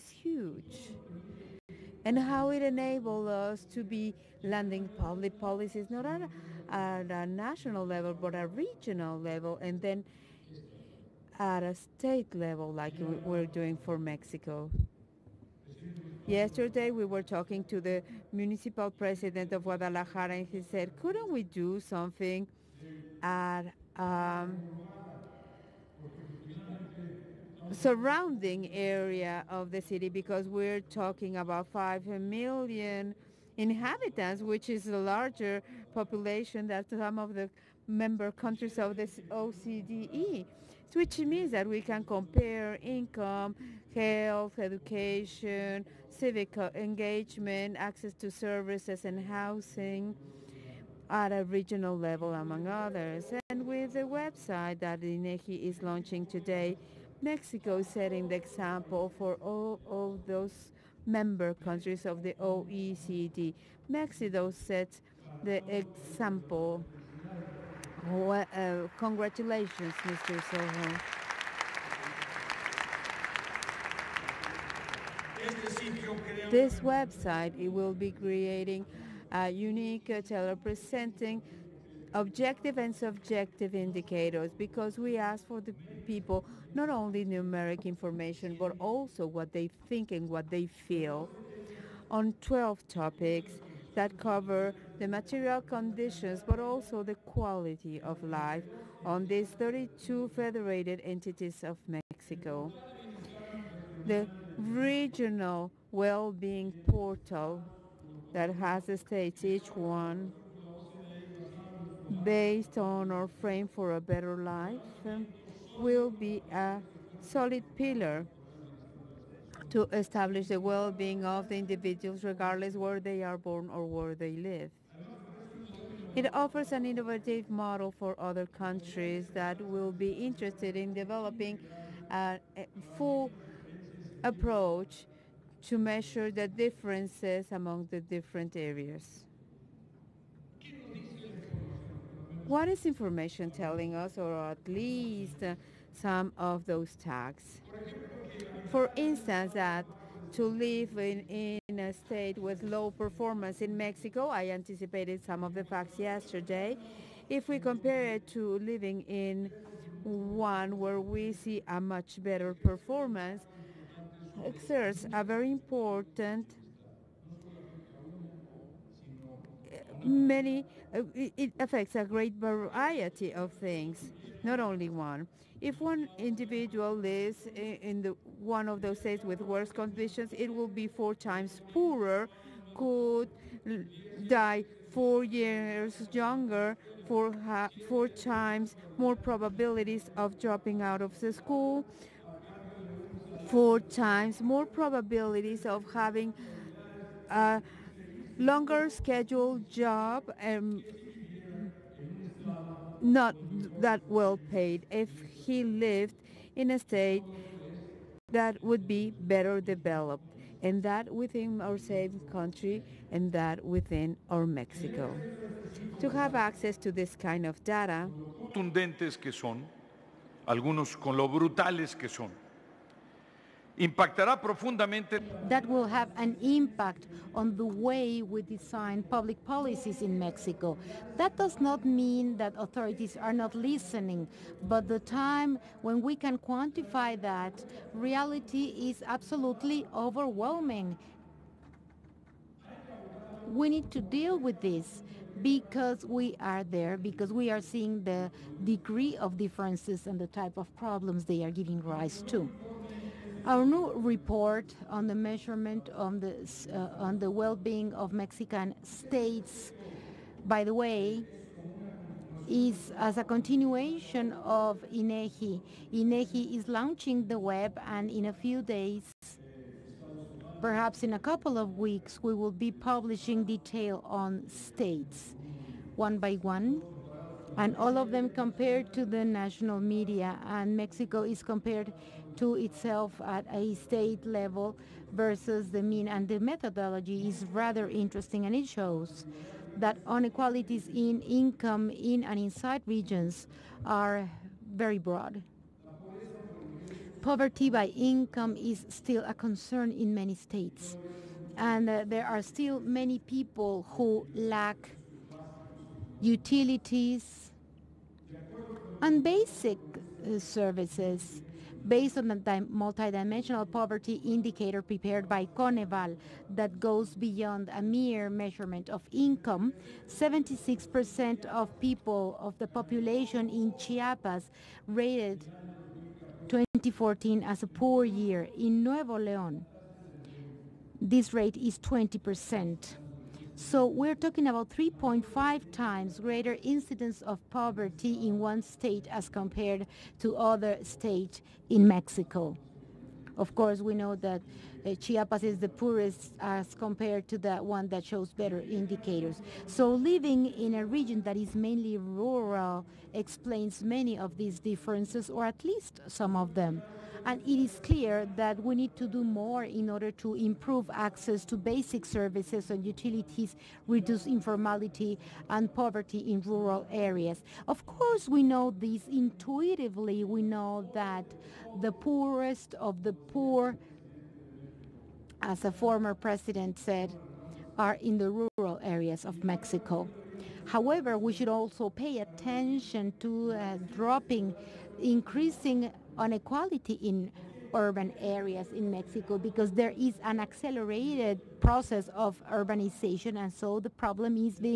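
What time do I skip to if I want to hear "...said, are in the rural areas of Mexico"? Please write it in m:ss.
6:16.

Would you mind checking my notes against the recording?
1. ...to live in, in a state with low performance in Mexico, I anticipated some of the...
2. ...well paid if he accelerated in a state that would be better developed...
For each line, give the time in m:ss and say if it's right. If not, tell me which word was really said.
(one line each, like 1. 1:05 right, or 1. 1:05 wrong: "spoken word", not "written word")
1. 2:30 right
2. 3:24 wrong: "lived", not "accelerated".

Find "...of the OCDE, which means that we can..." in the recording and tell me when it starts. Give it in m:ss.
0:38.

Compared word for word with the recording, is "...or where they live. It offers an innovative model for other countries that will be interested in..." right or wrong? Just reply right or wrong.
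right.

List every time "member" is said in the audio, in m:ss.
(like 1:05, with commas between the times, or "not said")
0:37, 1:01.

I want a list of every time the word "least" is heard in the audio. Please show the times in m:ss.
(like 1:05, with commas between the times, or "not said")
2:24, 5:55.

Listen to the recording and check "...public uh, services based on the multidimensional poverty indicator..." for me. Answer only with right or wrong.
wrong.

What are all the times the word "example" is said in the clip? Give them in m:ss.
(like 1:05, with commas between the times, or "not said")
0:58, 1:05.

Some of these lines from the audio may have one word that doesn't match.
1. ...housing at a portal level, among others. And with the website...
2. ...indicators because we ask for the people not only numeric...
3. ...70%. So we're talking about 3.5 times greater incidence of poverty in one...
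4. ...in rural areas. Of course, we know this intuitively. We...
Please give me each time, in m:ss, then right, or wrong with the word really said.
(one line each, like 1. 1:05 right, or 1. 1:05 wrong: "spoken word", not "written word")
1. 0:49 wrong: "regional", not "portal"
2. 1:23 right
3. 5:31 wrong: "20", not "70"
4. 6:06 right.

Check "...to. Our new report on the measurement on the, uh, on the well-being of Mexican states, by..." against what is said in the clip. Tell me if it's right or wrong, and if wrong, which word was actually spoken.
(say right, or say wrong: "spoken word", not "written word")
right.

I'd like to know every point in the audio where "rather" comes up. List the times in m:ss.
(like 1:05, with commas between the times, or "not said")
4:47.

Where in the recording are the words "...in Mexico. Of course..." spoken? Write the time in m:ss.
5:41.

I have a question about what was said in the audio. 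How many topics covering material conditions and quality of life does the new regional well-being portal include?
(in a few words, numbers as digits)
12.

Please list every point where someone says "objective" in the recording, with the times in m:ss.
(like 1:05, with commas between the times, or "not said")
1:22.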